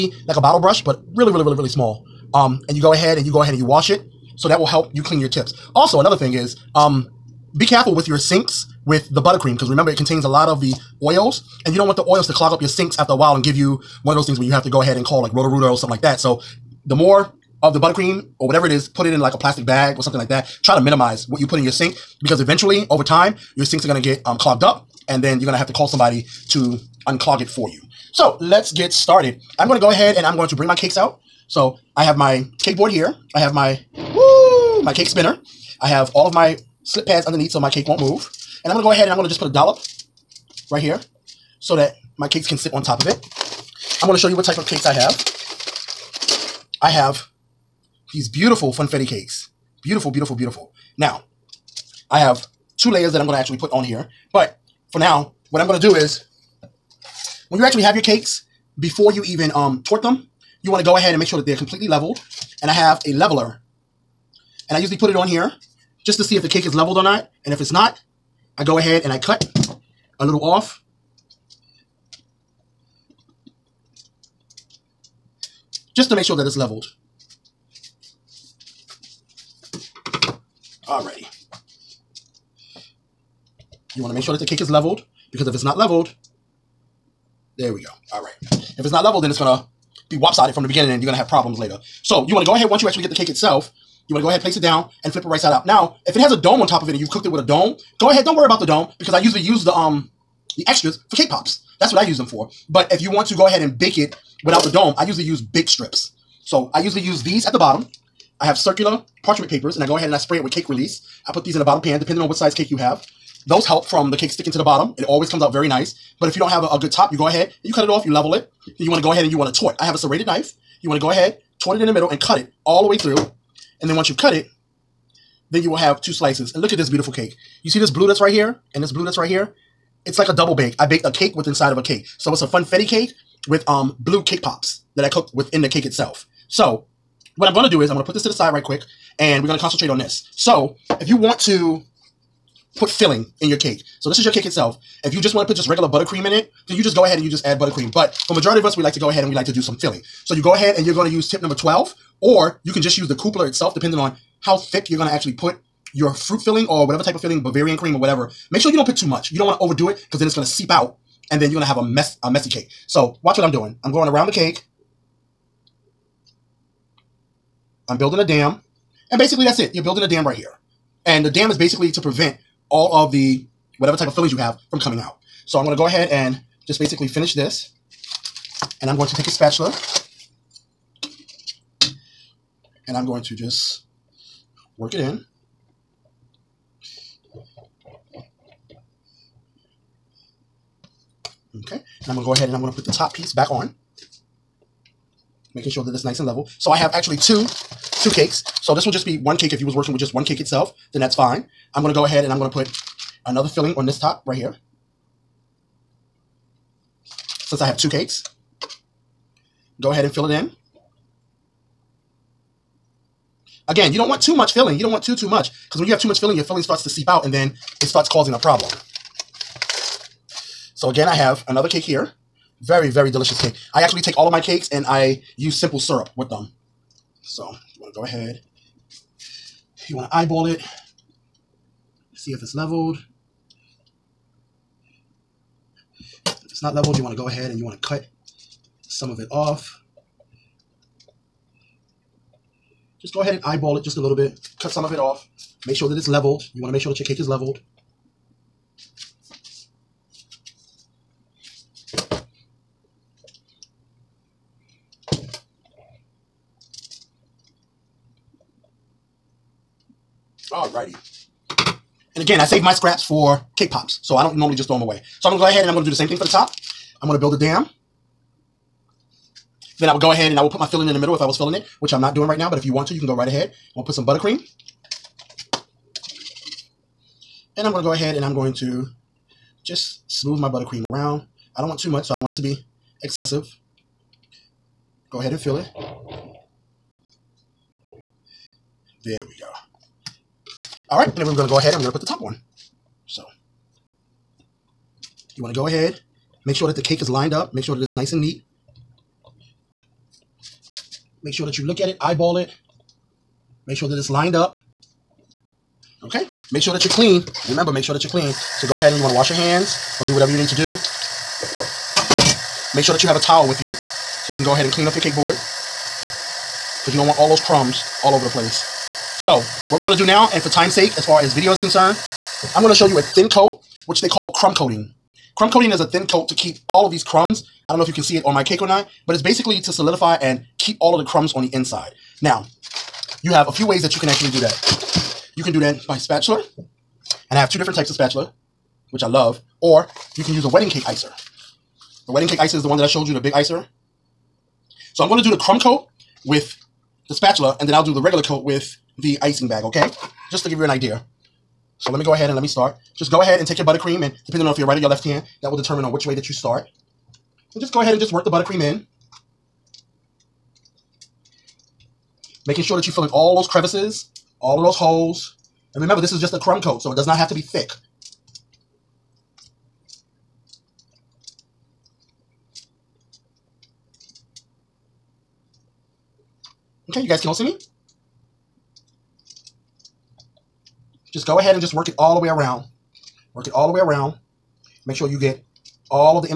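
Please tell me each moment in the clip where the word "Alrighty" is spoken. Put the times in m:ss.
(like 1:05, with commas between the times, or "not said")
1:20, 4:20.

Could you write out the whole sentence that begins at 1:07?
And if it's not, I go ahead and I cut a little off.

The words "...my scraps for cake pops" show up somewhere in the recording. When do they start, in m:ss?
4:22.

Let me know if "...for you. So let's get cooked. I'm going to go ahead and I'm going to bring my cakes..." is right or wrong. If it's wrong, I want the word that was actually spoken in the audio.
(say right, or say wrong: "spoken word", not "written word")
wrong: "started", not "cooked".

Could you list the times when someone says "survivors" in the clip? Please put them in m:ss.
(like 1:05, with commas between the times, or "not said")
not said.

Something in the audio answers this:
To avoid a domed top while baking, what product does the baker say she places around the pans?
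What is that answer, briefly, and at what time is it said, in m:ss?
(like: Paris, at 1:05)
Bake strips, at 1:45.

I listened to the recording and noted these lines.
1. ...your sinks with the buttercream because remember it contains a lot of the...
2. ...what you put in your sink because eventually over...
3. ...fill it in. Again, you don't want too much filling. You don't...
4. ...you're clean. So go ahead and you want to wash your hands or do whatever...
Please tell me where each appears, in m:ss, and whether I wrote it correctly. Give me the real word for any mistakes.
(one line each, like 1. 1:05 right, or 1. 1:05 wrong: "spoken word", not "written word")
1. 0:08 right
2. 0:21 right
3. 3:30 right
4. 5:08 right.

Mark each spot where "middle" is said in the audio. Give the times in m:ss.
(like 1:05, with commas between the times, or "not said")
2:01, 4:30.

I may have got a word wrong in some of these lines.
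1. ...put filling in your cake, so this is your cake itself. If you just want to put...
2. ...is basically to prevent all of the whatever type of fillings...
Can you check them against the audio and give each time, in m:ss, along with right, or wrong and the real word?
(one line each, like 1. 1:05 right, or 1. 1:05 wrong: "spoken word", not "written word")
1. 2:22 right
2. 2:51 right.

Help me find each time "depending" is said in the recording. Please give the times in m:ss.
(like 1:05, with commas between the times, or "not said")
1:51, 2:33, 5:54.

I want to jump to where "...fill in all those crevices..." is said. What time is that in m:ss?
6:02.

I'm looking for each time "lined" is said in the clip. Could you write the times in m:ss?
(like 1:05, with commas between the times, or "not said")
4:57, 5:04.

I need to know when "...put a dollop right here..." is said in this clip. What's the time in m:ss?
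0:39.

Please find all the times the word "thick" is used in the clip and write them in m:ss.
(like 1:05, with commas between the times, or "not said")
2:34, 6:07.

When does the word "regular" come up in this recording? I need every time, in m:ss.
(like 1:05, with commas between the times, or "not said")
2:25, 5:48.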